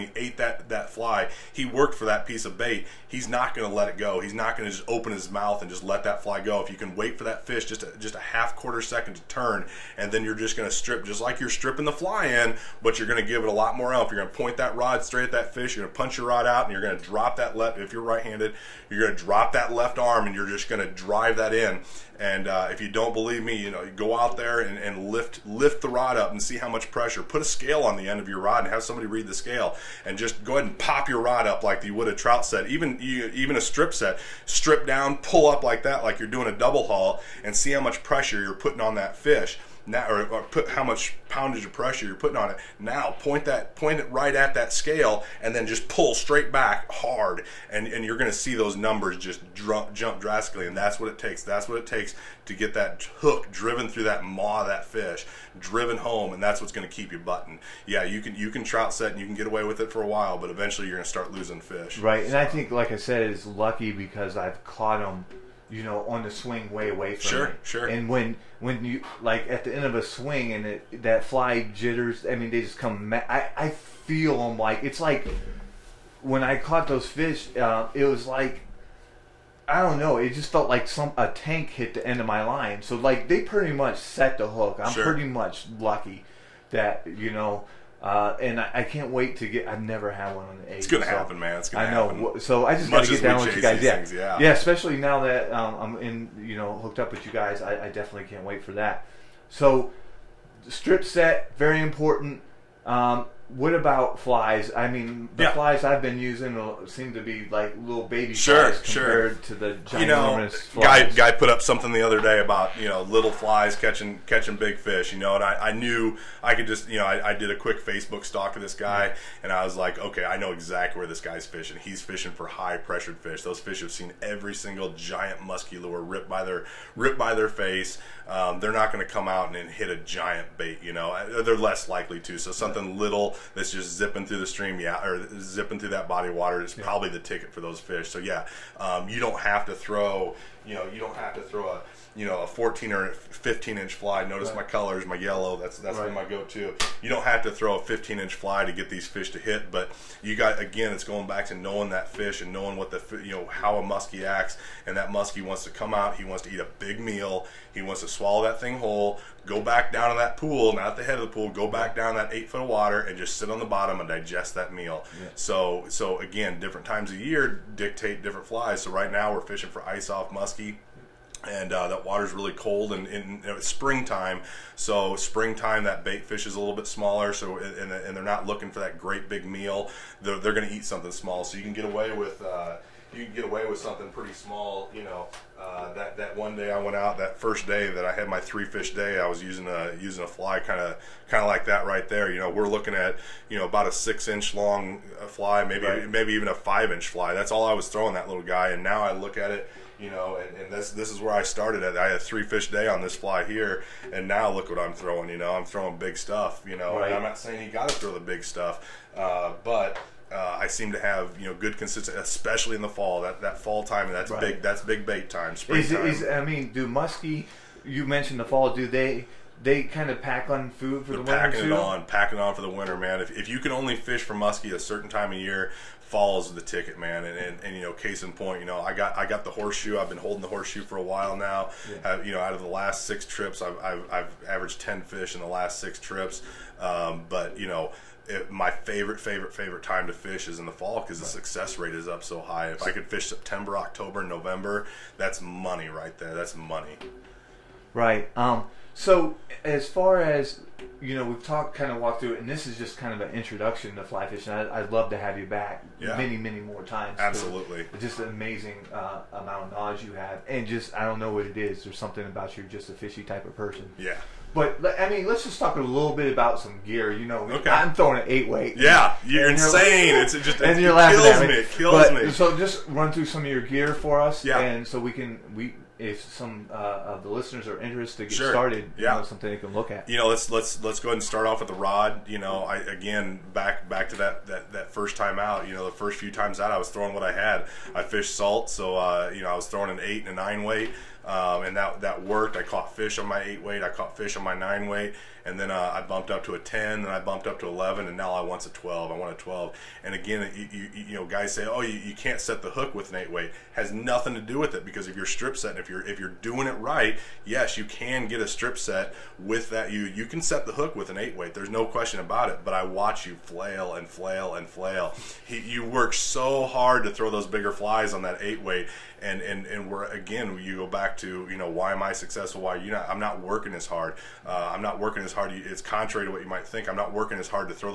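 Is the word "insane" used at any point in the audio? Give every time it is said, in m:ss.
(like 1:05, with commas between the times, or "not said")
4:29.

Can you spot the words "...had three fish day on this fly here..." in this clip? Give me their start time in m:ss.
3:22.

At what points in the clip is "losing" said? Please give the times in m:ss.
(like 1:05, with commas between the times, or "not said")
1:01.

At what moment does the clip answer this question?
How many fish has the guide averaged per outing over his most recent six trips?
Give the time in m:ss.
3:54.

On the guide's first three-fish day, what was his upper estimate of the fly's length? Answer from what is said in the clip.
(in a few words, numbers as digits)
6 inches.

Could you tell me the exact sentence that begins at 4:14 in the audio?
I, would love to have you back yeah.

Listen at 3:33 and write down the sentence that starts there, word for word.
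That that fall time, that's right.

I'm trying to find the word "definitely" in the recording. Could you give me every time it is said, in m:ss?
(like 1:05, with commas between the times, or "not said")
1:37.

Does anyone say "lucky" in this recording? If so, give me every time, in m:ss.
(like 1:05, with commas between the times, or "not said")
1:03, 1:25.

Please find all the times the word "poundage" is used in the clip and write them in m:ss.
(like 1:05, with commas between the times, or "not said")
0:41.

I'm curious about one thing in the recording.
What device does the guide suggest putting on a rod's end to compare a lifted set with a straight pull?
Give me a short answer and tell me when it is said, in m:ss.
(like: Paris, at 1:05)
A scale, at 0:27.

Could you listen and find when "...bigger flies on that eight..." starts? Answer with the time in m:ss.
5:17.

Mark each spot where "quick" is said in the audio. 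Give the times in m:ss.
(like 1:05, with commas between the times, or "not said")
1:57.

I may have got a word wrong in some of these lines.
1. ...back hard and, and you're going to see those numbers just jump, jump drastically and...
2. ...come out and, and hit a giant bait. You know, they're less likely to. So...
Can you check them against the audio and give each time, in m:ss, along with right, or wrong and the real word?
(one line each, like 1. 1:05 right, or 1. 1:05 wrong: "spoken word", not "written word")
1. 0:46 right
2. 2:09 right.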